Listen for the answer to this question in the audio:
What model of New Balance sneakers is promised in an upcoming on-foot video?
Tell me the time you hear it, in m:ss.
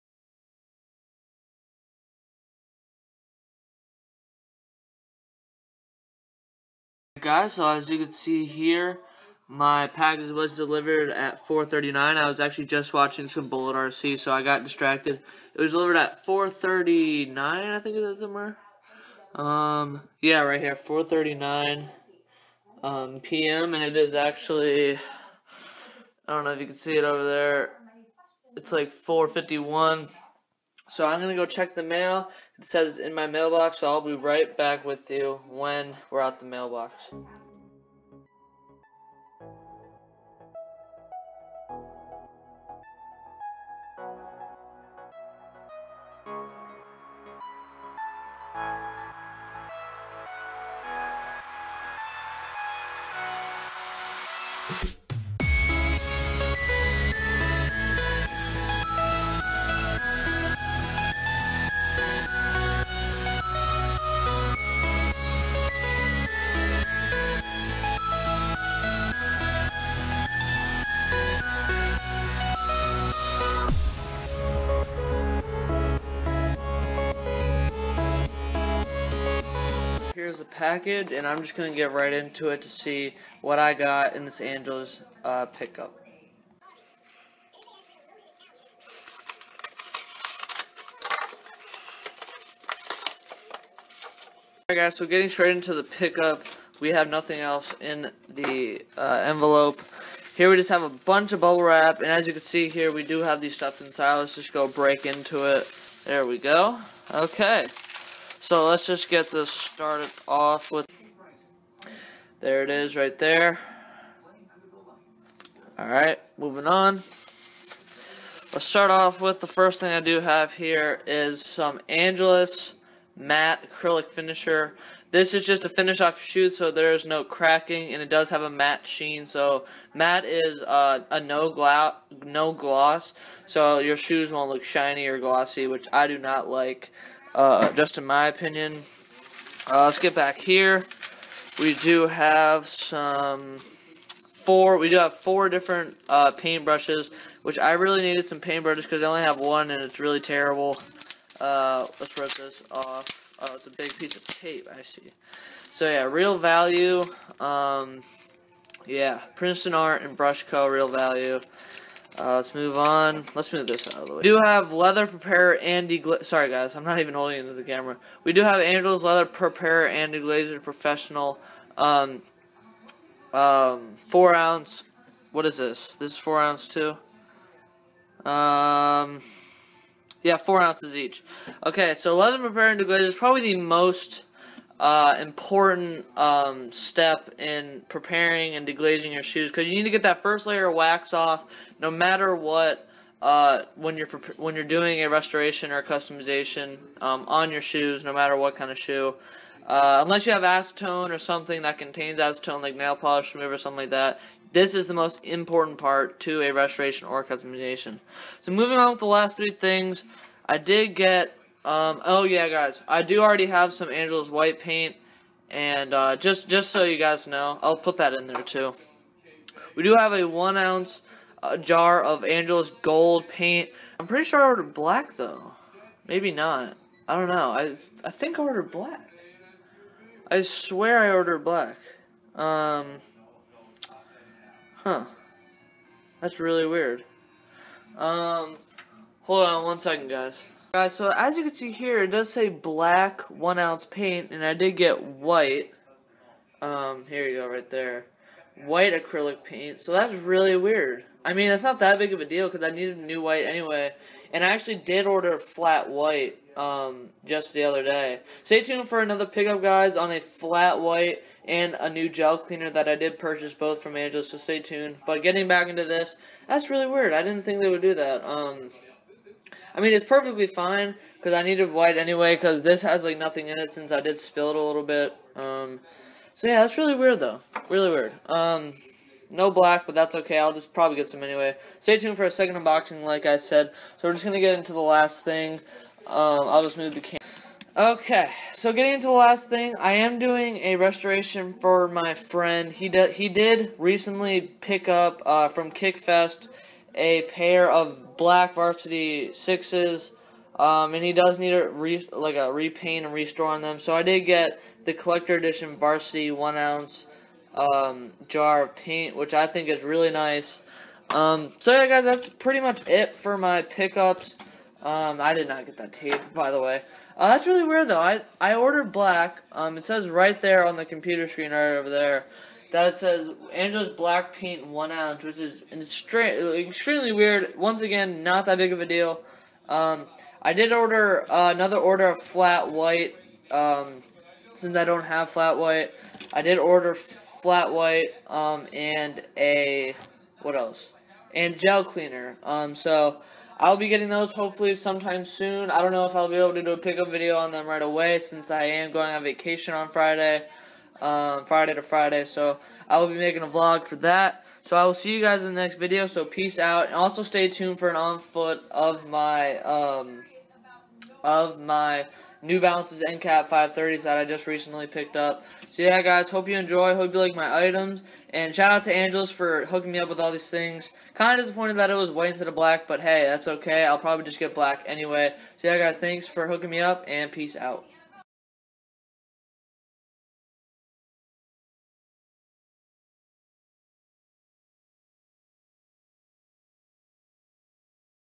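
6:03.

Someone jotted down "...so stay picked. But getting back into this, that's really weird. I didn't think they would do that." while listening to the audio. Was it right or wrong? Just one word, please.
wrong.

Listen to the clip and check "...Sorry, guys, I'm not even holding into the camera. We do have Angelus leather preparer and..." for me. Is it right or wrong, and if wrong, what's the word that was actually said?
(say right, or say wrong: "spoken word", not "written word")
right.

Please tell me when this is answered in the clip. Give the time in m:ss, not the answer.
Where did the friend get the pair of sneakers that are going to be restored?
4:55.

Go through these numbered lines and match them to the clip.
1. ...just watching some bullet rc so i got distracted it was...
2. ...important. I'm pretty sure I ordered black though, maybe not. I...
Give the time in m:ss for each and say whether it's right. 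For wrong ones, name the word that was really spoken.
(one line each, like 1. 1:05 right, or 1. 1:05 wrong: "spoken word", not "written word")
1. 0:12 right
2. 3:43 wrong: "paint", not "important".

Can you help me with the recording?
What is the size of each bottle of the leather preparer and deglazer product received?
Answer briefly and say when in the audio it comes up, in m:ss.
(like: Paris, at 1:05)
4 ounces, at 3:00.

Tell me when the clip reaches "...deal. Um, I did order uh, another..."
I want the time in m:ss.
5:28.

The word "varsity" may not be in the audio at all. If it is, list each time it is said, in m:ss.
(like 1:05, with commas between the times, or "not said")
4:58, 5:05.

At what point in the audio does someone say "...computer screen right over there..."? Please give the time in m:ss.
5:20.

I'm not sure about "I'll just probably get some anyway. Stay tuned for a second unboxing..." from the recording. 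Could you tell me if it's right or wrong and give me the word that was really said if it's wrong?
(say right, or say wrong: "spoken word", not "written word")
right.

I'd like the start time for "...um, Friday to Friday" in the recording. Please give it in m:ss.
5:51.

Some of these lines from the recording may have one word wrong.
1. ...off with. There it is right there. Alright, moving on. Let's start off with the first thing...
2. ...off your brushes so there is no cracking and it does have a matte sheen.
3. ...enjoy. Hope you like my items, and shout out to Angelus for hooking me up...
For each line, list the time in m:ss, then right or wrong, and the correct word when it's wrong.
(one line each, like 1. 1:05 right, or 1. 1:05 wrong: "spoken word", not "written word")
1. 1:50 right
2. 2:06 wrong: "shoes", not "brushes"
3. 6:06 right.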